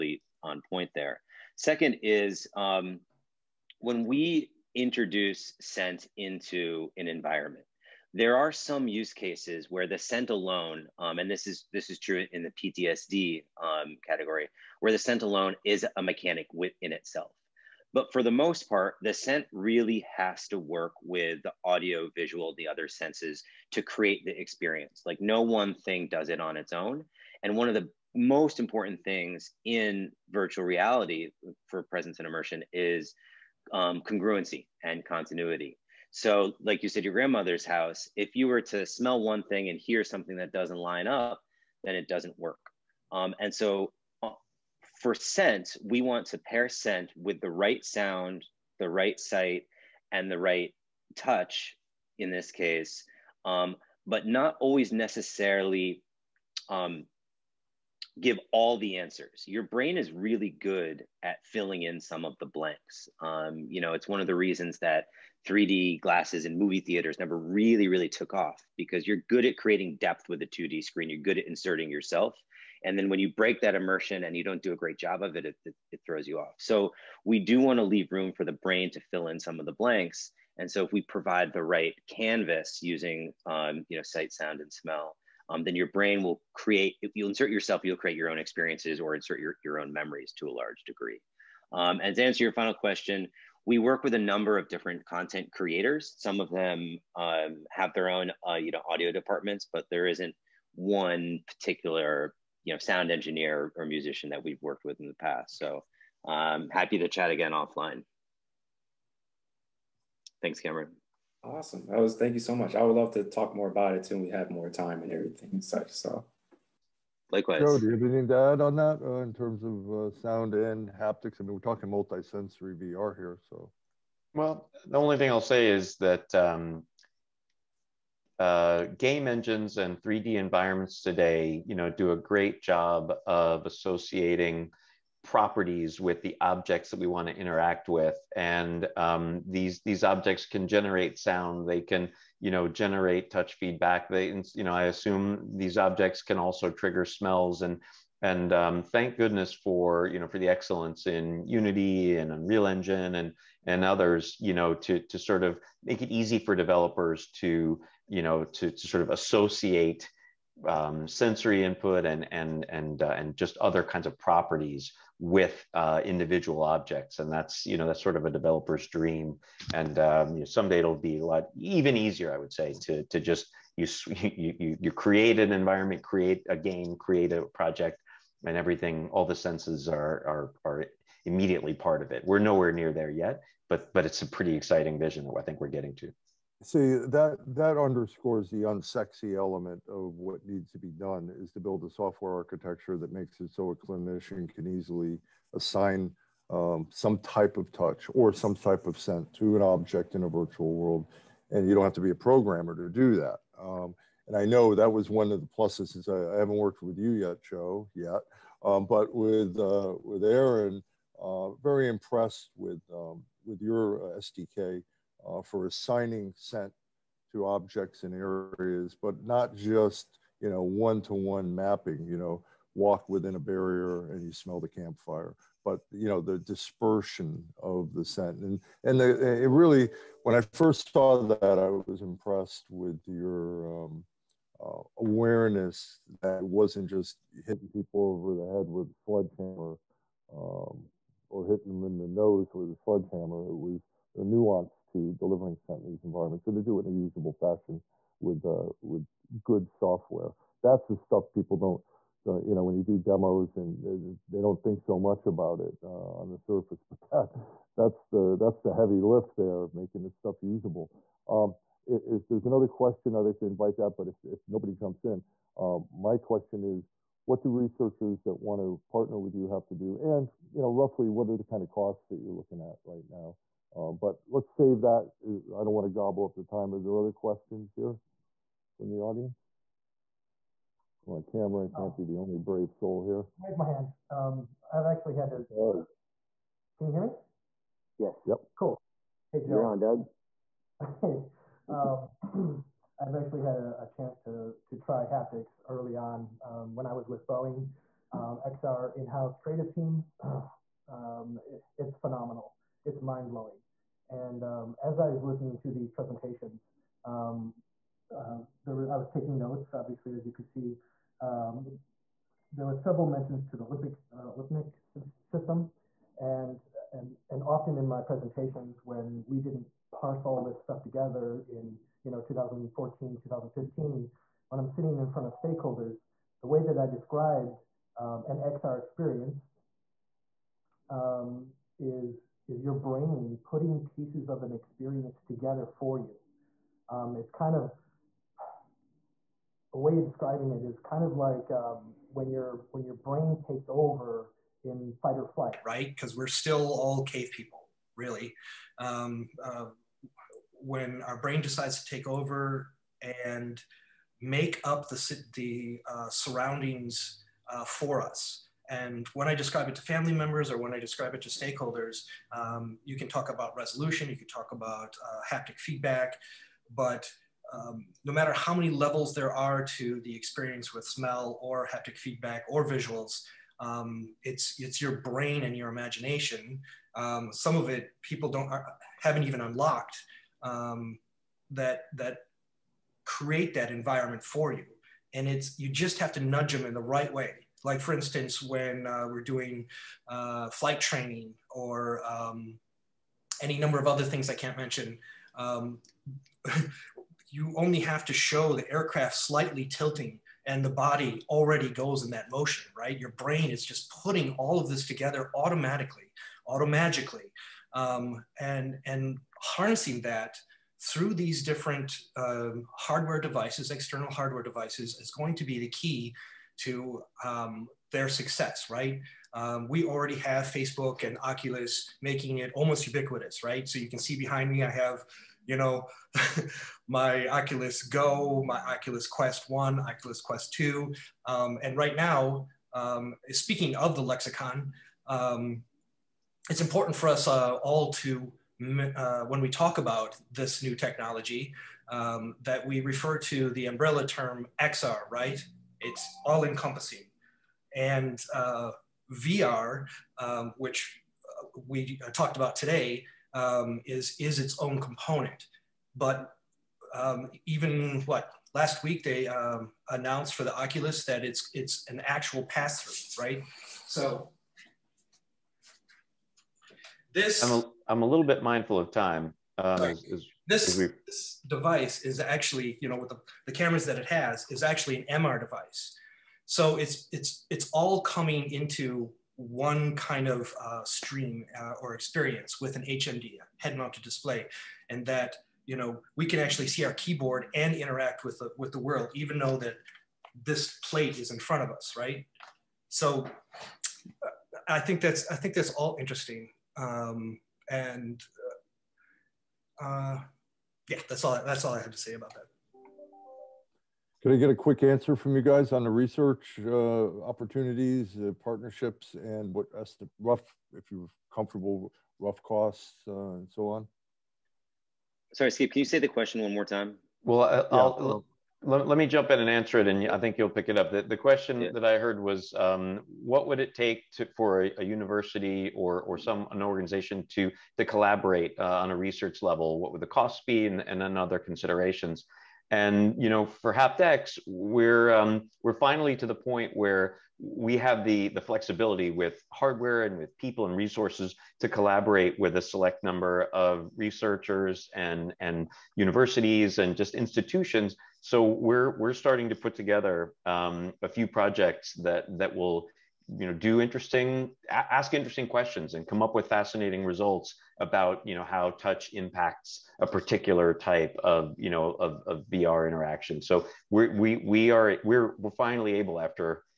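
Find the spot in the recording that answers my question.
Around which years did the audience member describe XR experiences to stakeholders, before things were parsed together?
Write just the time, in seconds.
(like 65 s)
322 s.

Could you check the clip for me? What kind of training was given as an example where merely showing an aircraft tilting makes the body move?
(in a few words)
flight training.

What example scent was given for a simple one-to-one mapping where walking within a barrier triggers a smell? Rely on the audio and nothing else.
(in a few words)
campfire.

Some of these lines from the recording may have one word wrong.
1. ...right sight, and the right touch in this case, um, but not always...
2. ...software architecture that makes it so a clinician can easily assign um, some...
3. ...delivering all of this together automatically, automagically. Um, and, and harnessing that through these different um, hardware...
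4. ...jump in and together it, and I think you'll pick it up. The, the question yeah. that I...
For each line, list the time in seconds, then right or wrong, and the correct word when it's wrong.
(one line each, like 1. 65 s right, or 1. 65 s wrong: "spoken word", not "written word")
1. 48 s right
2. 191 s right
3. 403 s wrong: "putting", not "delivering"
4. 519 s wrong: "answer", not "together".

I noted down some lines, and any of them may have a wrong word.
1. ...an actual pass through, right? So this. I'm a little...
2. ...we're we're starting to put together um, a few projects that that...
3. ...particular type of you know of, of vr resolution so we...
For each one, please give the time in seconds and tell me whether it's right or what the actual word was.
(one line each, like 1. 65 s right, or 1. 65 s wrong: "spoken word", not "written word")
1. 461 s right
2. 548 s right
3. 560 s wrong: "interaction", not "resolution".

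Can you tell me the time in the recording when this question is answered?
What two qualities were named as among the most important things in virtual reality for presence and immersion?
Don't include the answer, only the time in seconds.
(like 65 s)
34 s.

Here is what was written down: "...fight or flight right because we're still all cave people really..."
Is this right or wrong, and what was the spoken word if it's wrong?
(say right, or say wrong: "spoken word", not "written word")
right.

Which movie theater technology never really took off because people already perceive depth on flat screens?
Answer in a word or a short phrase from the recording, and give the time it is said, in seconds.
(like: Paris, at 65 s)
3D glasses, at 65 s.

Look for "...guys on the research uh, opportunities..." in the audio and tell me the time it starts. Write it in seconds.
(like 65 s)
505 s.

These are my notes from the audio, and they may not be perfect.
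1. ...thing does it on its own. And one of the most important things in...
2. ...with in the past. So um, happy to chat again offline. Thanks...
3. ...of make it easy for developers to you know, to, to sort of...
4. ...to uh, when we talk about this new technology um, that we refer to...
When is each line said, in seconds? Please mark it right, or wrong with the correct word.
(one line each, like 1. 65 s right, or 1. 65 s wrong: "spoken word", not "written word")
1. 25 s right
2. 104 s right
3. 155 s right
4. 437 s right.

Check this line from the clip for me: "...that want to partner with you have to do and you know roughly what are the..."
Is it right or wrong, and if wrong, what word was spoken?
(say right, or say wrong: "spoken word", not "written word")
right.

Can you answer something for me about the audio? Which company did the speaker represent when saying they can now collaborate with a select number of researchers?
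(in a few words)
HaptX.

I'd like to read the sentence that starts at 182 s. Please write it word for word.
We're nowhere near there yet, but but it's a pretty exciting vision that I think we're getting to.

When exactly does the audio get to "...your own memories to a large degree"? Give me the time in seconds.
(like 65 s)
89 s.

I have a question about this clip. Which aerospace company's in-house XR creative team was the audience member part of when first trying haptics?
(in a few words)
Boeing.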